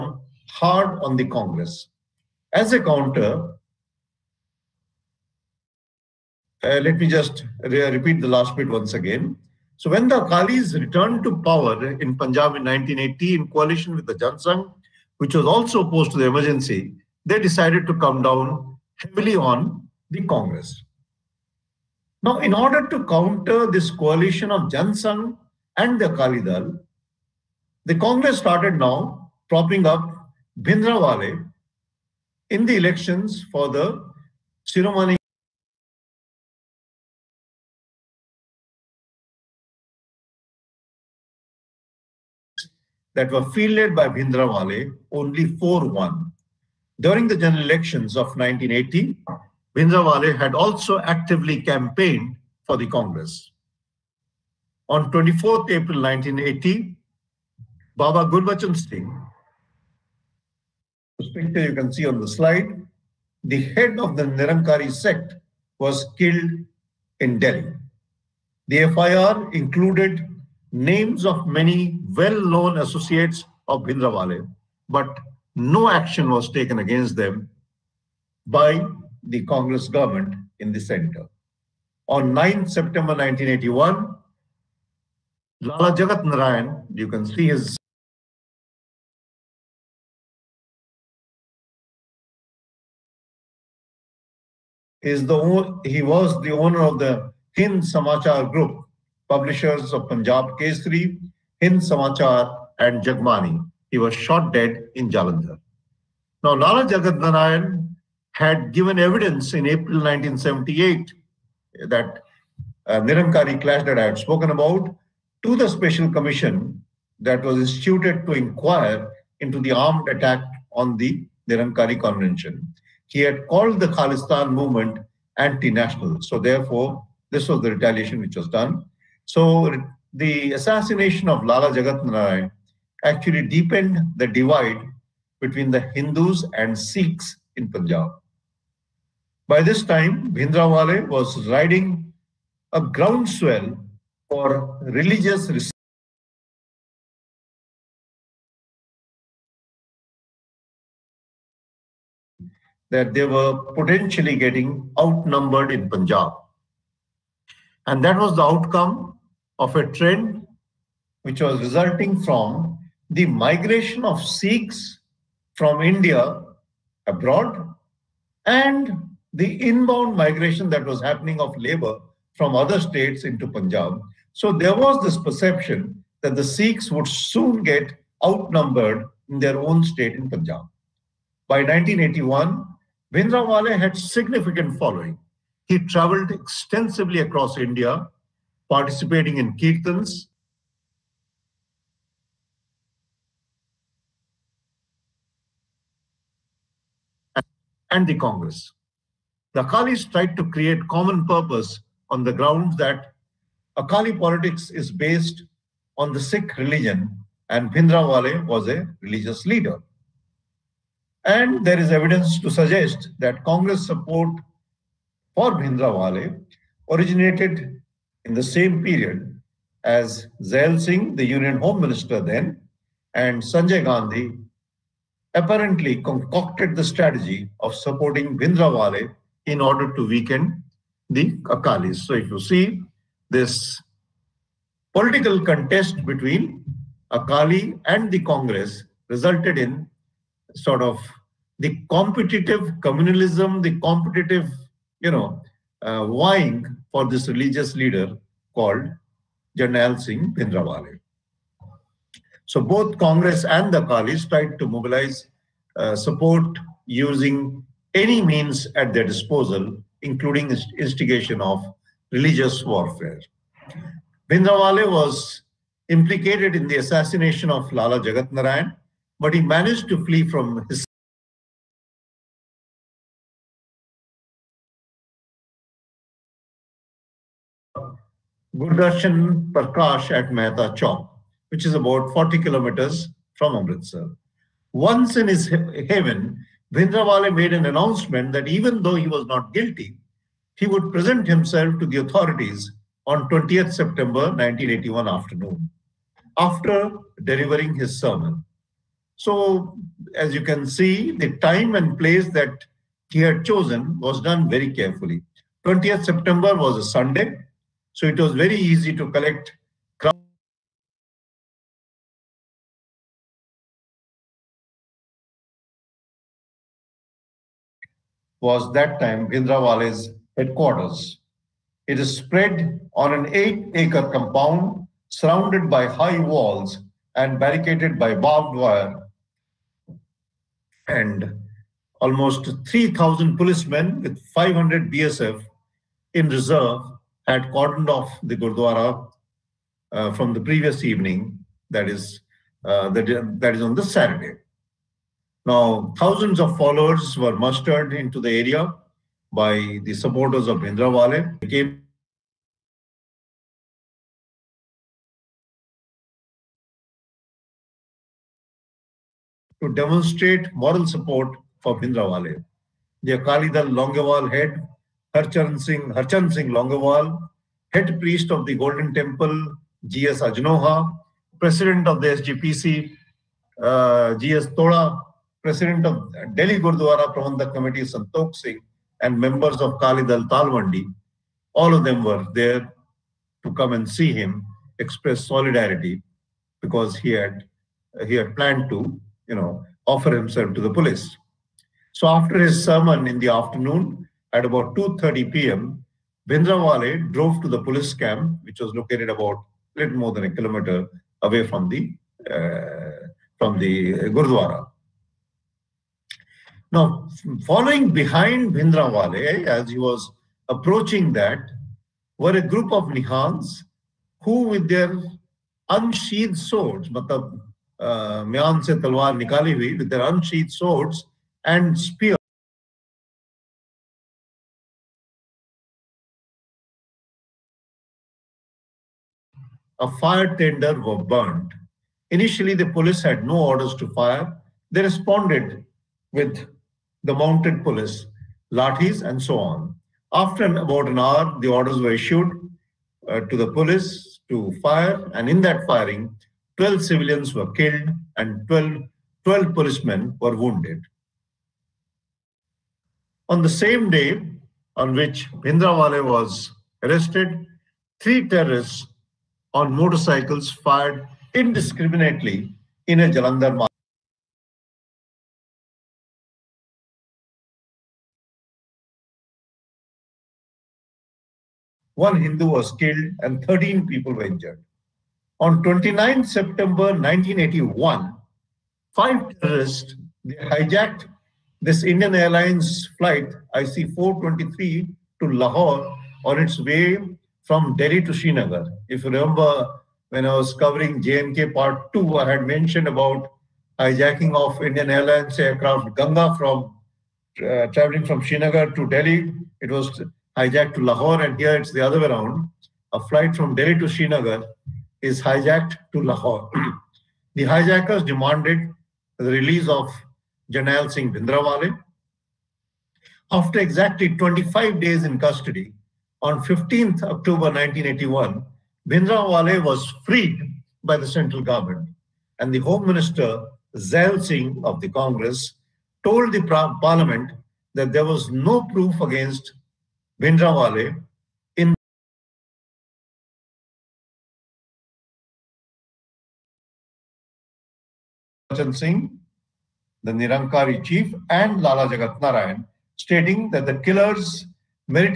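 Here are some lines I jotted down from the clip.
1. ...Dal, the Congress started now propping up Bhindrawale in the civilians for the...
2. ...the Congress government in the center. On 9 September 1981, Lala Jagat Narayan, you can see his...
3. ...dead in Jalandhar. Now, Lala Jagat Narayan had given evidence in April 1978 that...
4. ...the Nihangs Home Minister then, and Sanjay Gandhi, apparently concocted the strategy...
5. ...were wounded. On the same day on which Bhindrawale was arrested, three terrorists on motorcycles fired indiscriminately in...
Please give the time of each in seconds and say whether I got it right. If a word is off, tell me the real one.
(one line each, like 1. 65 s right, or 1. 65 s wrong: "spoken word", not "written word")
1. 26 s wrong: "elections", not "civilians"
2. 79 s right
3. 104 s right
4. 221 s wrong: "Union", not "Nihangs"
5. 450 s right.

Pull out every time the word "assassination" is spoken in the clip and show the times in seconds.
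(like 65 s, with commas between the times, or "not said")
130 s, 266 s.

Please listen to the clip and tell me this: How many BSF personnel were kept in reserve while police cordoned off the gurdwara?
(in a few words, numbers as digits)
500.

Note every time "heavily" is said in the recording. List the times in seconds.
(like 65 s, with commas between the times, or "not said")
18 s.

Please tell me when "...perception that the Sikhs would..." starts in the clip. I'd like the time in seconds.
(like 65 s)
175 s.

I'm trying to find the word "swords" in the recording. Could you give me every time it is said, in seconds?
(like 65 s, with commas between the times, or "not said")
416 s, 420 s.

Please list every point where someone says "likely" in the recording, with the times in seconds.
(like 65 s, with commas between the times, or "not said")
not said.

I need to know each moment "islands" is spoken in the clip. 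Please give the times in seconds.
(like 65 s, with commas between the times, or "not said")
not said.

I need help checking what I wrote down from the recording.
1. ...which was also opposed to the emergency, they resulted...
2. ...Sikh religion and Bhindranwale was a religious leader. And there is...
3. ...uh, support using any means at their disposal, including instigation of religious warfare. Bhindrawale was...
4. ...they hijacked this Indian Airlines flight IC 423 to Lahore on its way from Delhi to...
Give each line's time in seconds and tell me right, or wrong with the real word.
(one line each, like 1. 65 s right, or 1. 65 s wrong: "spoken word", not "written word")
1. 15 s wrong: "decided", not "resulted"
2. 206 s right
3. 255 s right
4. 480 s right.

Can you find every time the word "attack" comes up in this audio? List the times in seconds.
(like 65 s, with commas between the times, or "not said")
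120 s.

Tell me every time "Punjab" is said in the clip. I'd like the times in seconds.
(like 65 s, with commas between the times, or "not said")
12 s, 100 s, 137 s, 155 s, 173 s, 180 s.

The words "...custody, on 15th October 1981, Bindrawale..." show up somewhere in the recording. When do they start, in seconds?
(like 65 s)
515 s.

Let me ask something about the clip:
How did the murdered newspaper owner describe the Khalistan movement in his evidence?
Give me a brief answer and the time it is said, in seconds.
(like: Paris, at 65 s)
Anti national, at 125 s.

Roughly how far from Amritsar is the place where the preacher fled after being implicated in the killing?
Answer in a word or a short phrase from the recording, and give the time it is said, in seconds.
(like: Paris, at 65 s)
40 kilometers, at 282 s.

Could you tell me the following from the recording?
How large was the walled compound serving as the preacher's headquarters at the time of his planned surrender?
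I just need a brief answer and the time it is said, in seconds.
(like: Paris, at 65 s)
8 acres, at 323 s.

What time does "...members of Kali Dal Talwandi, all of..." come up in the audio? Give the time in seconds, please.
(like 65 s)
379 s.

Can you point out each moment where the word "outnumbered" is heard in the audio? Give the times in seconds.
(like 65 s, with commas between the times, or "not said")
154 s, 178 s.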